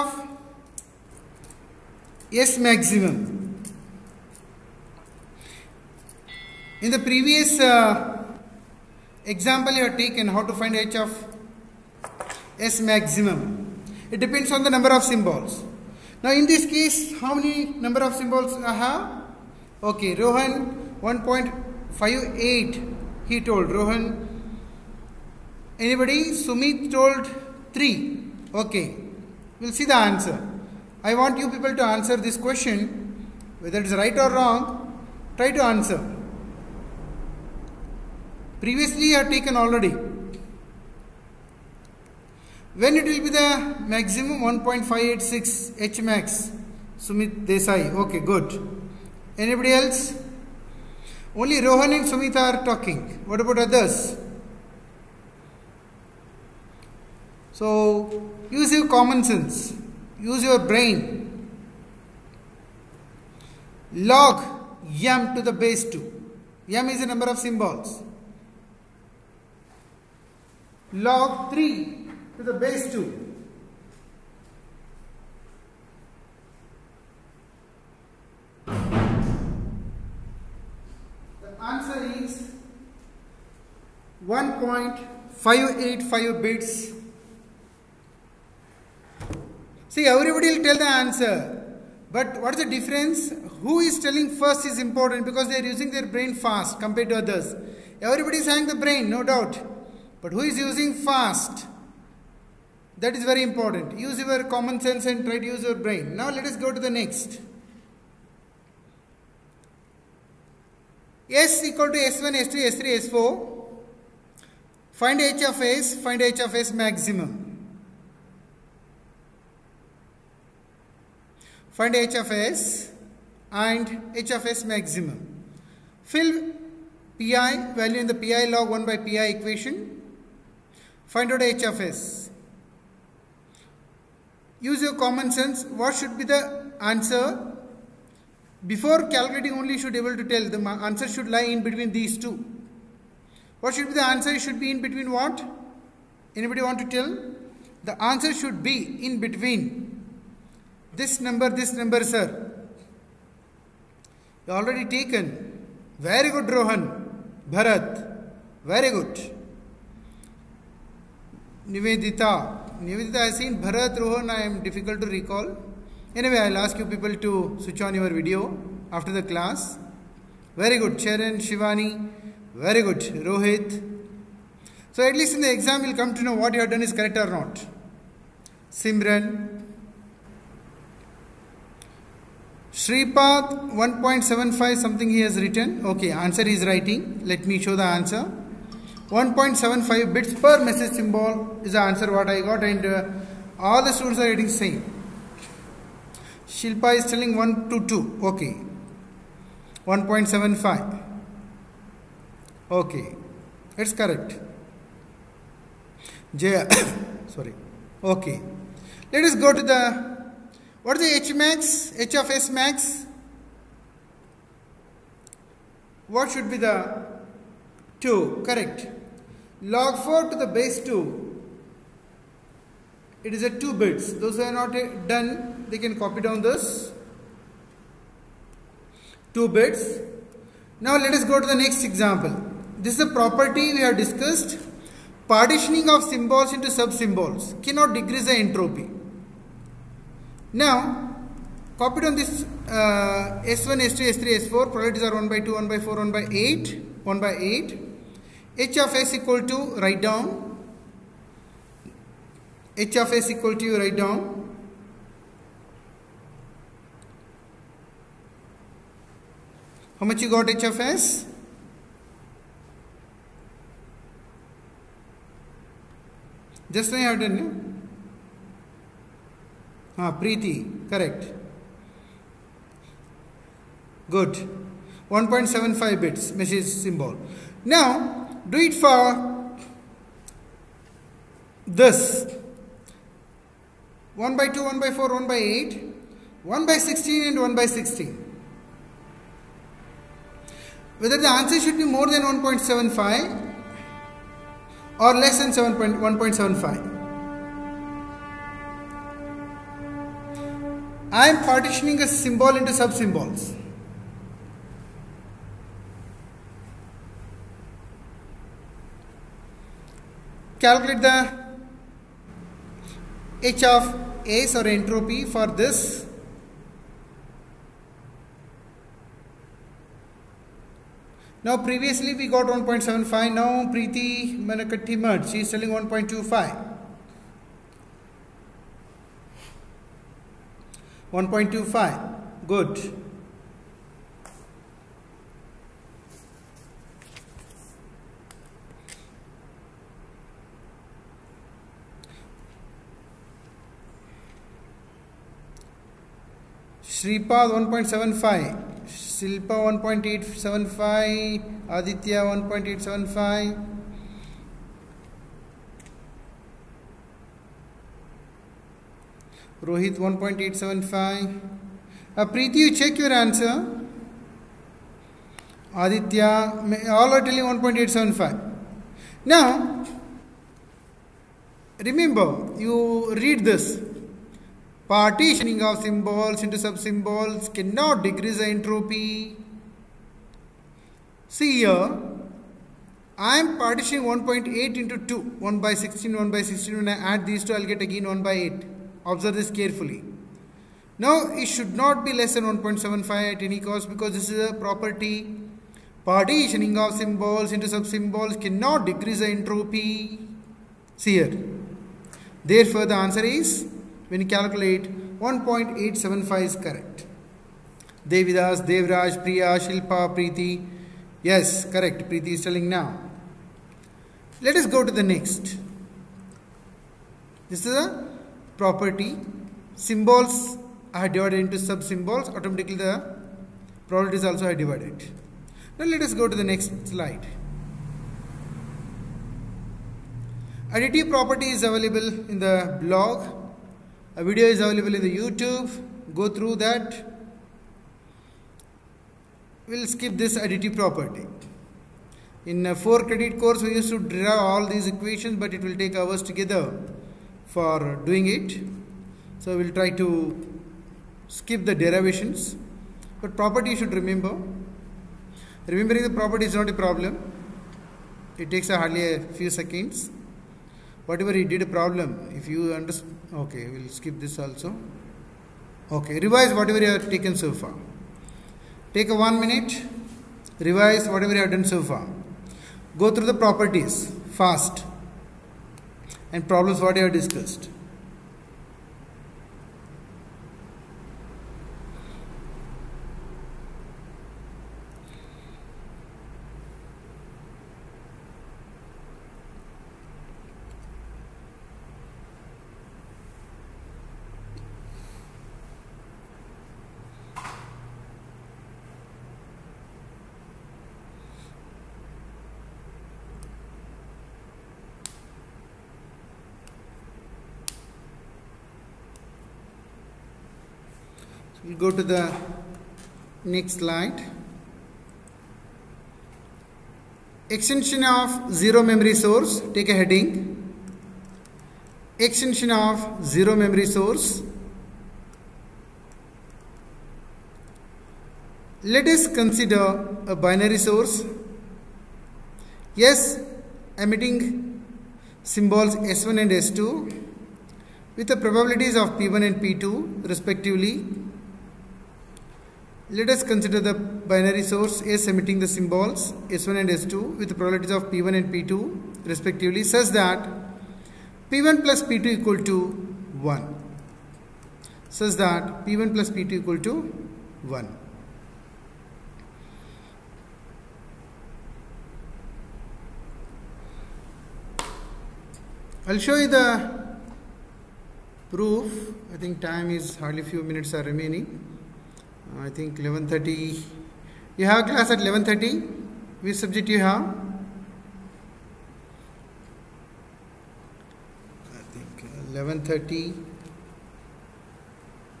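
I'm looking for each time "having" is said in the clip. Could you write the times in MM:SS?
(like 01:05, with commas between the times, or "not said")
01:38.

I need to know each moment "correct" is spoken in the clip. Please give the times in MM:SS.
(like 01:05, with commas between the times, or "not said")
02:56, 03:23, 03:38, 04:30, 06:46, 06:51.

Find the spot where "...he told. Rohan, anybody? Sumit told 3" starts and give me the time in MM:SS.
00:23.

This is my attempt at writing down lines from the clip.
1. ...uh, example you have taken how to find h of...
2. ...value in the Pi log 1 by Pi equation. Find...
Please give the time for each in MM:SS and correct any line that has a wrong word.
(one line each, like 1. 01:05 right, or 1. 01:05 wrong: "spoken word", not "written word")
1. 00:07 right
2. 02:07 right.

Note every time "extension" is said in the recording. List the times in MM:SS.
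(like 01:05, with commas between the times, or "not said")
08:37, 08:42.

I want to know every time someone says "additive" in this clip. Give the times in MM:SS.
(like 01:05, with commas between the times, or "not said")
07:10, 07:20.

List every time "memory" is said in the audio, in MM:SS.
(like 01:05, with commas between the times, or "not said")
08:38, 08:43.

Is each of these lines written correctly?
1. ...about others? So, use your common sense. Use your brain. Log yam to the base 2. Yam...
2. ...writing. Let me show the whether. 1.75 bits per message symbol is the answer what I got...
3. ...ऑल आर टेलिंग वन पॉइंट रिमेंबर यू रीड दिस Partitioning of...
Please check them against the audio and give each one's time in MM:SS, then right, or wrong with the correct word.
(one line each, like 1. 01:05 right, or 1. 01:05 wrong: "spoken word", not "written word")
1. 00:53 right
2. 03:06 wrong: "answer", not "whether"
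3. 06:07 right.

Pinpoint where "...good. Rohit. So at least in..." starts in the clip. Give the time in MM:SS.
02:52.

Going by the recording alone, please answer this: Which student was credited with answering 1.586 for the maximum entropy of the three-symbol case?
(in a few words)
Sumit Desai.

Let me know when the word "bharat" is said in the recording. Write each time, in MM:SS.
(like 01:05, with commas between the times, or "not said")
02:37, 02:43.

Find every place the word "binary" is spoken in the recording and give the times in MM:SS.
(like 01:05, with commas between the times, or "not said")
08:50, 09:03.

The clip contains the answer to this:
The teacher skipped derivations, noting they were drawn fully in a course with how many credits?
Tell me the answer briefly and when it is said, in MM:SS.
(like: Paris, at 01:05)
4, at 07:22.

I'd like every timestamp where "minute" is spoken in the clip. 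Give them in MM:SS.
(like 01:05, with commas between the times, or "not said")
07:49, 09:30.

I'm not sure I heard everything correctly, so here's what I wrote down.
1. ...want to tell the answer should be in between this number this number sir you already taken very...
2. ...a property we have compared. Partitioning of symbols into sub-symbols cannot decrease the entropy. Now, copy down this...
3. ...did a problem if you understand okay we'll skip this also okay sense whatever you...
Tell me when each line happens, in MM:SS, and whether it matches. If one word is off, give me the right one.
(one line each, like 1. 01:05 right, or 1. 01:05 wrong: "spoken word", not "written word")
1. 02:26 right
2. 03:53 wrong: "discussed", not "compared"
3. 07:41 wrong: "revise", not "sense".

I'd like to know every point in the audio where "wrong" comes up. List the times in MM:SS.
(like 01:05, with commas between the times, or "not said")
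00:34.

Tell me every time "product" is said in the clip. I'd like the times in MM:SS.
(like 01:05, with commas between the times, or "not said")
07:03.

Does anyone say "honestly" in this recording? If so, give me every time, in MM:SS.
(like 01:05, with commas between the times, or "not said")
not said.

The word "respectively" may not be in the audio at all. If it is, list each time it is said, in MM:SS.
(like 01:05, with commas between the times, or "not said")
09:00, 09:09.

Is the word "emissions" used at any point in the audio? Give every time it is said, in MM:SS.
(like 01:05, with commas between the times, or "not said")
not said.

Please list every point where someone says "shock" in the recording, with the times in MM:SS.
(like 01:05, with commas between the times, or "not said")
not said.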